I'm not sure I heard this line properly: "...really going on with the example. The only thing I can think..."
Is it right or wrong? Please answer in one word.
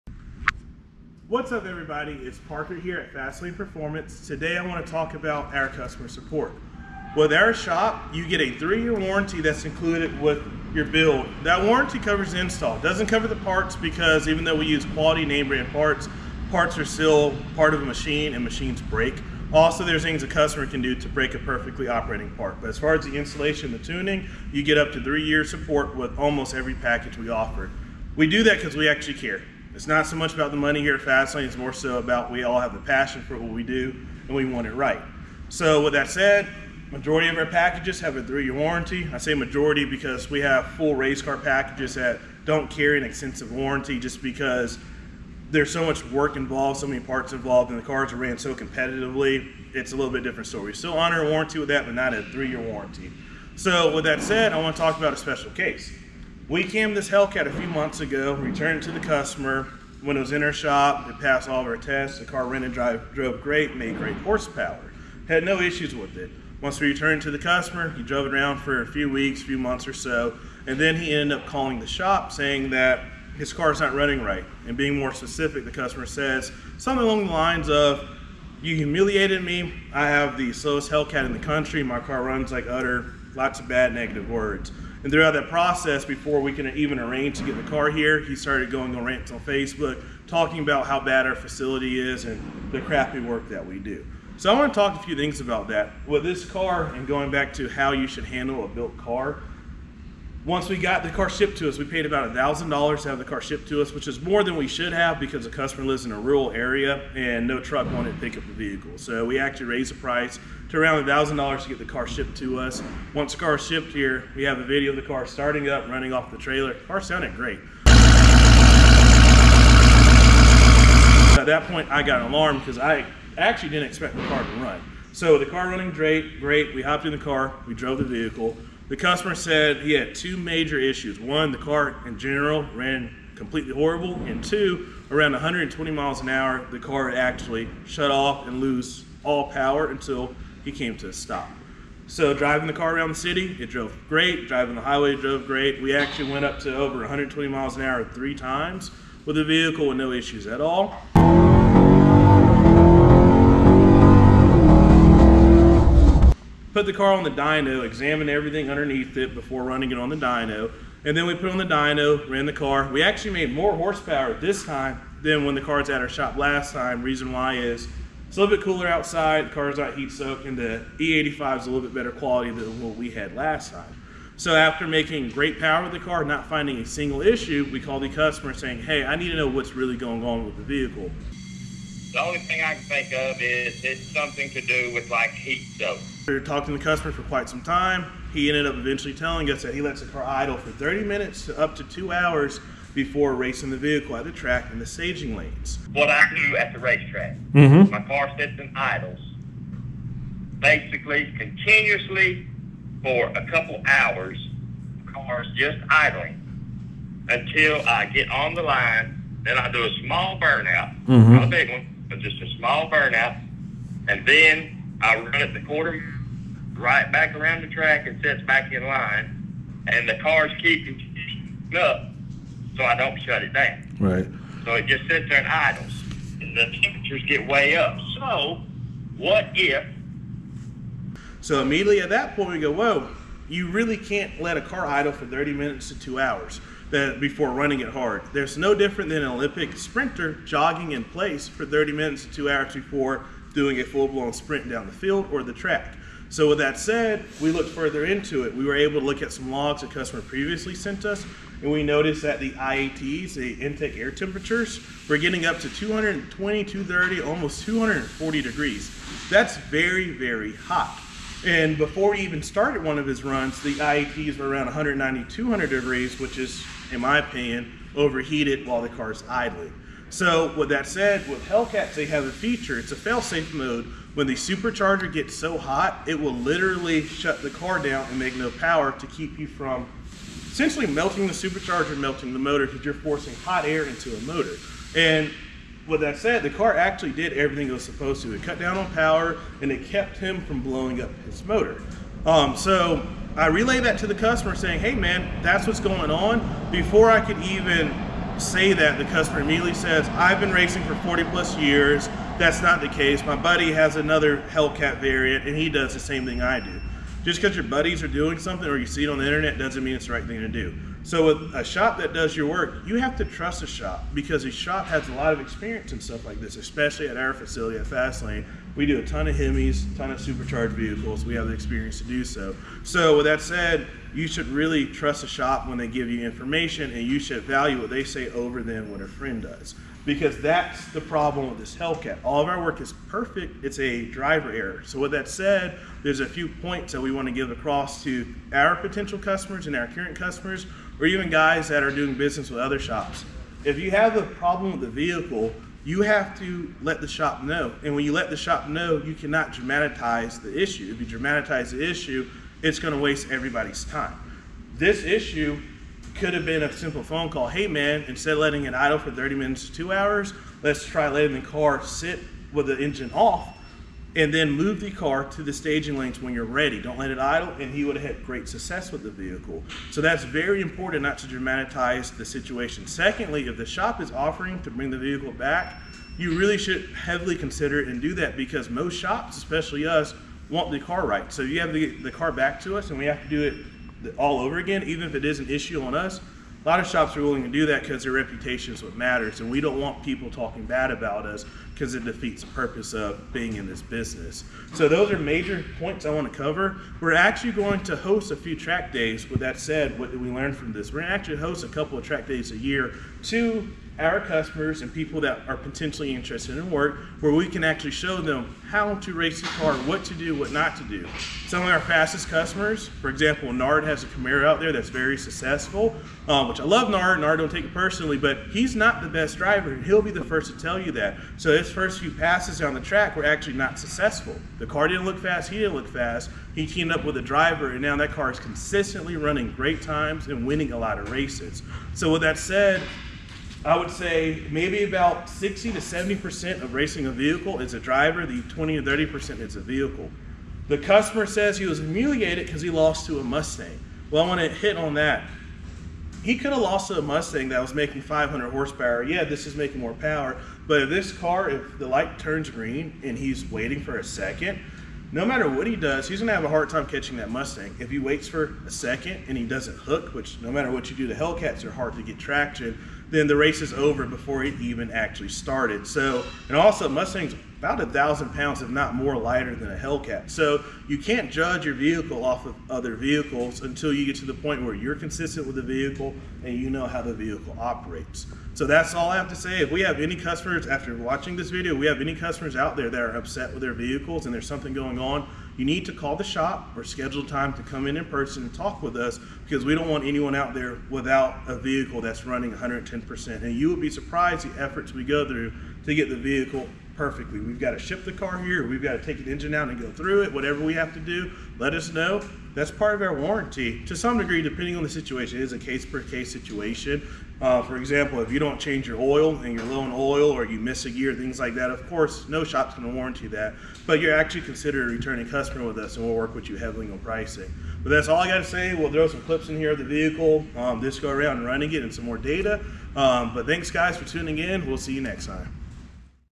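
wrong.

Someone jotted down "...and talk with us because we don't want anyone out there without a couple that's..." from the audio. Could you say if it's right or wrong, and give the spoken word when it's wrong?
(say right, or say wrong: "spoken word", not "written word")
wrong: "vehicle", not "couple".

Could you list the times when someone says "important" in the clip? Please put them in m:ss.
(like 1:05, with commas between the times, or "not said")
6:10.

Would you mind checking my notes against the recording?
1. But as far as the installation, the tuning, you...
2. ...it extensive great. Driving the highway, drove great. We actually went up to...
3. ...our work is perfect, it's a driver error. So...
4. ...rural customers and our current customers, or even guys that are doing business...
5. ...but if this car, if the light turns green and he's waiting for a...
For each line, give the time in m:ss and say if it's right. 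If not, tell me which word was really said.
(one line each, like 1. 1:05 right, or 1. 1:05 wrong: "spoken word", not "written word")
1. 0:22 right
2. 2:23 wrong: "drove", not "extensive"
3. 5:32 right
4. 5:38 wrong: "potential", not "rural"
5. 7:30 right.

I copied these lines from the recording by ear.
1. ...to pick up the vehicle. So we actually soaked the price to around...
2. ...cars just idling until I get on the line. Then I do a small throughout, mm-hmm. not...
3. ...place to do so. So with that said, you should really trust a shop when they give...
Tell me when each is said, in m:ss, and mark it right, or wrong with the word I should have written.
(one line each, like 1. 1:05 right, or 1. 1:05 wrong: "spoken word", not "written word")
1. 1:48 wrong: "raised", not "soaked"
2. 3:25 wrong: "burnout", not "throughout"
3. 5:21 wrong: "experience", not "place".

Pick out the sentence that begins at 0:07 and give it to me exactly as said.
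With our shop, you get a three-year warranty that's included with your build.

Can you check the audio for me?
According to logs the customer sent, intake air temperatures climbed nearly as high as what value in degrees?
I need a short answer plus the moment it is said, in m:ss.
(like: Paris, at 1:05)
240, at 4:17.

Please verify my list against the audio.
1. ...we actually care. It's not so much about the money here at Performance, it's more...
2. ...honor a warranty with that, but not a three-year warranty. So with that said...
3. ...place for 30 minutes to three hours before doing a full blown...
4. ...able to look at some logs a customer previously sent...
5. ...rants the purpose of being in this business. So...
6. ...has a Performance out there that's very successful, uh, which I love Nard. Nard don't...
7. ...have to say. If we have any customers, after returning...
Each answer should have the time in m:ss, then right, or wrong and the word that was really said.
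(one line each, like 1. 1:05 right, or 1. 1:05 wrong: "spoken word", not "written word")
1. 0:28 wrong: "Fastlane", not "Performance"
2. 0:50 right
3. 4:01 wrong: "two", not "three"
4. 4:08 right
5. 6:32 wrong: "defeats", not "rants"
6. 6:53 wrong: "Camaro", not "Performance"
7. 7:59 wrong: "watching", not "returning".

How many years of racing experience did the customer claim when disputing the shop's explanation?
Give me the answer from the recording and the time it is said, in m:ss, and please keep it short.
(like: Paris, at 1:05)
40+, at 5:00.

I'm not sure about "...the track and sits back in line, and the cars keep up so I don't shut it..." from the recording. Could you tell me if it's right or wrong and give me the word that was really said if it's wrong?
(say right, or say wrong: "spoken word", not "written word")
right.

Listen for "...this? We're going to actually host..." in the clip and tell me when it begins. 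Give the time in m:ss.
6:40.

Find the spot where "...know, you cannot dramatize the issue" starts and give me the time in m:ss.
5:48.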